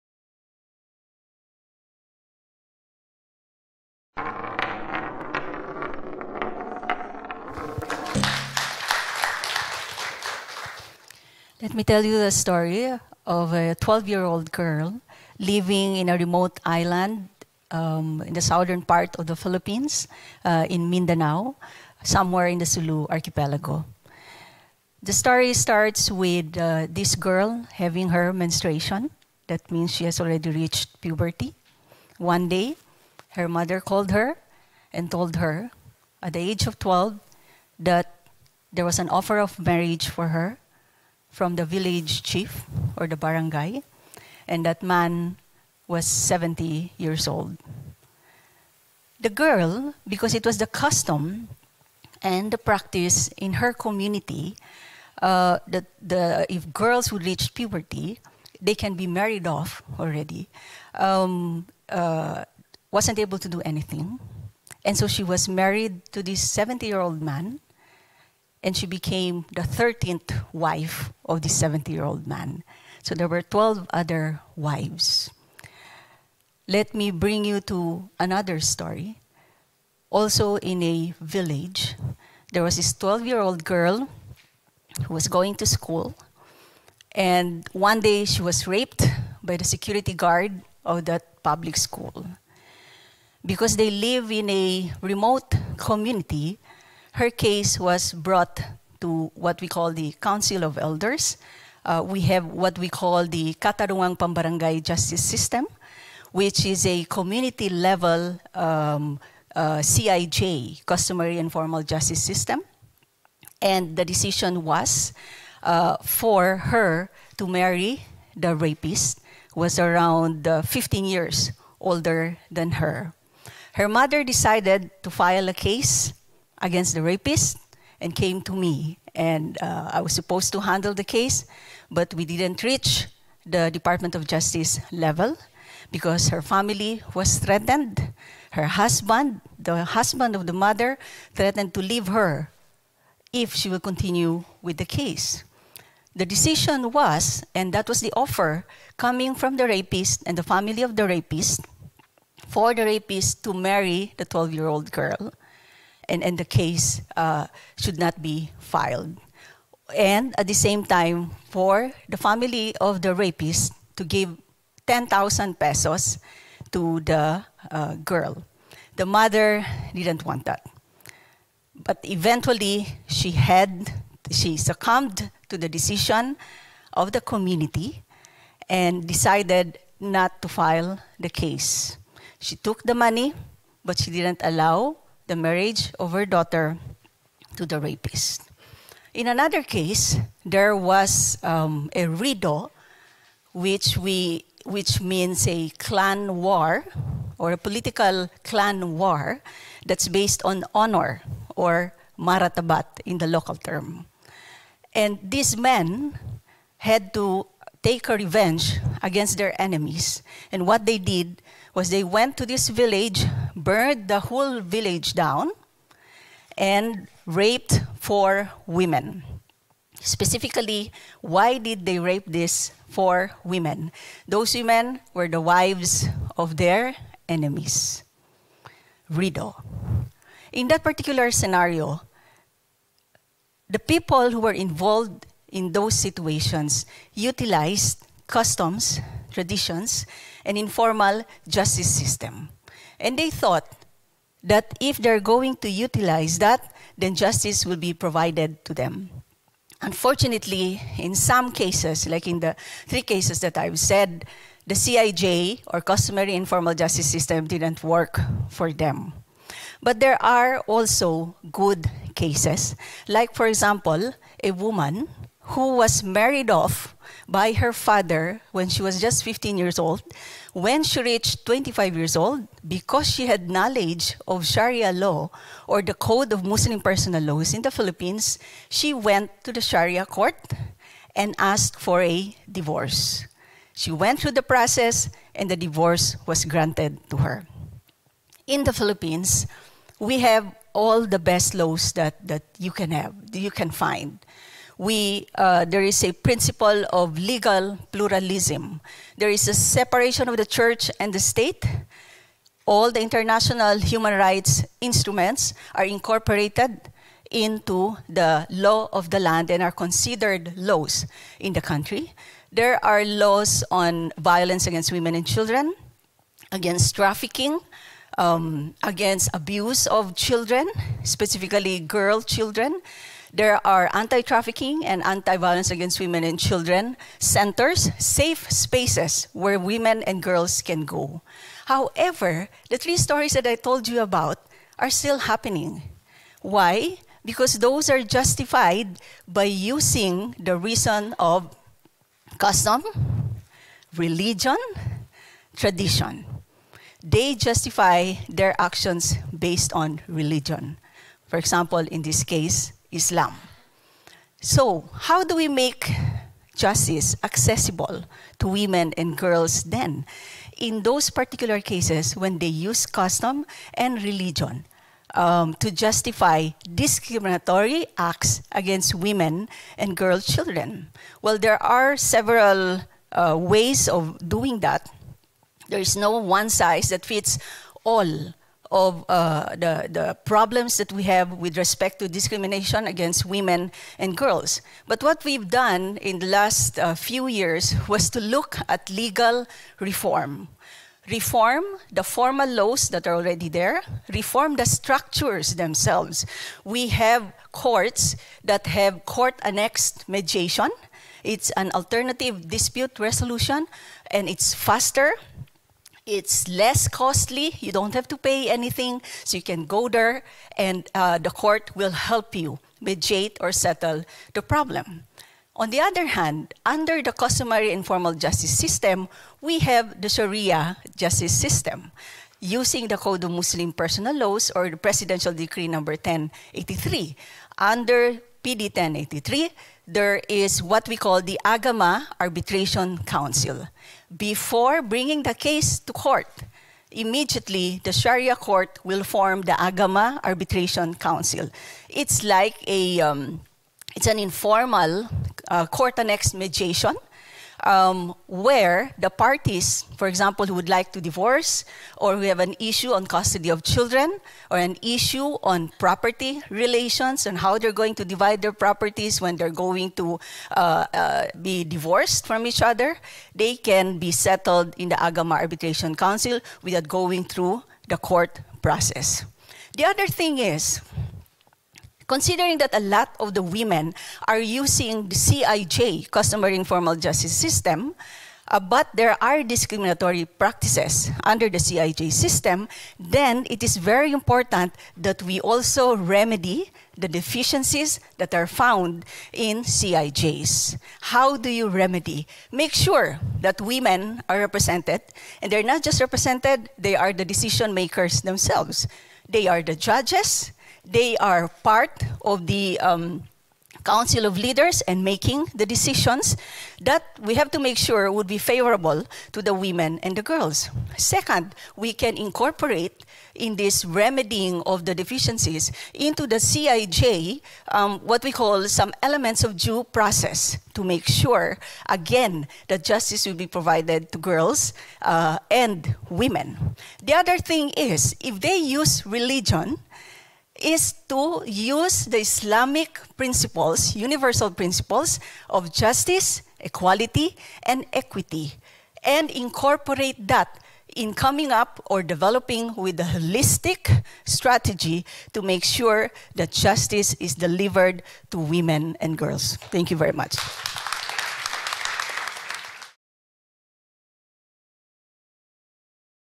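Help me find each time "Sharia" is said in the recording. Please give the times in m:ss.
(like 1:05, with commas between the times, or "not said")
4:34, 4:39, 7:00, 7:17.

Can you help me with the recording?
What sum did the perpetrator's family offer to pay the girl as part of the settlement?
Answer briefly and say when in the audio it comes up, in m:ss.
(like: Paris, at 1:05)
10,000 pesos, at 2:44.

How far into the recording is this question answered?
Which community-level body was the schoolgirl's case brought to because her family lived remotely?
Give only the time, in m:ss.
1:40.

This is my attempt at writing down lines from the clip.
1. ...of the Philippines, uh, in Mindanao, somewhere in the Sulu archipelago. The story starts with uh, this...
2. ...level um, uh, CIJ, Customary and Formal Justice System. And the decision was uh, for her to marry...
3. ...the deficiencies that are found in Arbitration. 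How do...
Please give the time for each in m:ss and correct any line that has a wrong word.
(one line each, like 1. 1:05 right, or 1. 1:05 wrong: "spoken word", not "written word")
1. 0:19 right
2. 1:47 right
3. 8:06 wrong: "CIJs", not "Arbitration".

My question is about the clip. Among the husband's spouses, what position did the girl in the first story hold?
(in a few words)
13th wife.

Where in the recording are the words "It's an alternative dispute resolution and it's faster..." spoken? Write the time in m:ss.
6:41.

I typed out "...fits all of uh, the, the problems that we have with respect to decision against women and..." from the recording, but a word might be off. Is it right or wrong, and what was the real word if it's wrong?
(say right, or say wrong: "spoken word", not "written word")
wrong: "discrimination", not "decision".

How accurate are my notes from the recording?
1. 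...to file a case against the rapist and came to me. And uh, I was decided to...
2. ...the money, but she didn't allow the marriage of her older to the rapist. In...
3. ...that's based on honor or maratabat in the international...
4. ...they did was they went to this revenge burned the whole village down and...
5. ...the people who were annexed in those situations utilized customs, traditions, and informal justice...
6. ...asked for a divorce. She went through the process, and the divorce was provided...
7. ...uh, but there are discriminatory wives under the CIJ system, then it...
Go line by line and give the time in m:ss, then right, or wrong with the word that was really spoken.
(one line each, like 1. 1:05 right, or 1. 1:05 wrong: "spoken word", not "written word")
1. 2:05 wrong: "supposed", not "decided"
2. 3:02 wrong: "daughter", not "older"
3. 3:19 wrong: "local", not "international"
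4. 3:30 wrong: "village", not "revenge"
5. 3:53 wrong: "involved", not "annexed"
6. 4:41 wrong: "granted", not "provided"
7. 7:58 wrong: "practices", not "wives".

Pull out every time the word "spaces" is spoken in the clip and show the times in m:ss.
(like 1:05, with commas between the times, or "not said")
5:28.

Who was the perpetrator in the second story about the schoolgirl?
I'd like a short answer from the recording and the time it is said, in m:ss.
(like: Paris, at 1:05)
Security guard, at 1:29.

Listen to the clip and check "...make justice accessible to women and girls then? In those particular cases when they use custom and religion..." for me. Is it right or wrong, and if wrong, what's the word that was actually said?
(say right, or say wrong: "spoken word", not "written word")
right.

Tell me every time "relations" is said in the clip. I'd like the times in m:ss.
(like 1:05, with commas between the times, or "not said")
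7:36.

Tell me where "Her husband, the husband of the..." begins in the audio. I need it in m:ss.
2:18.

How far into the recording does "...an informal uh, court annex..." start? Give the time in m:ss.
7:24.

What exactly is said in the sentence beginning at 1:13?
So there were 12 other wives.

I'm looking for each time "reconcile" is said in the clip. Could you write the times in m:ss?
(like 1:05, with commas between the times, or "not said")
not said.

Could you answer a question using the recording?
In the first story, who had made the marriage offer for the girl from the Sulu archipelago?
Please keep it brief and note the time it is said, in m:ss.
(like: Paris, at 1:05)
Village chief, at 0:41.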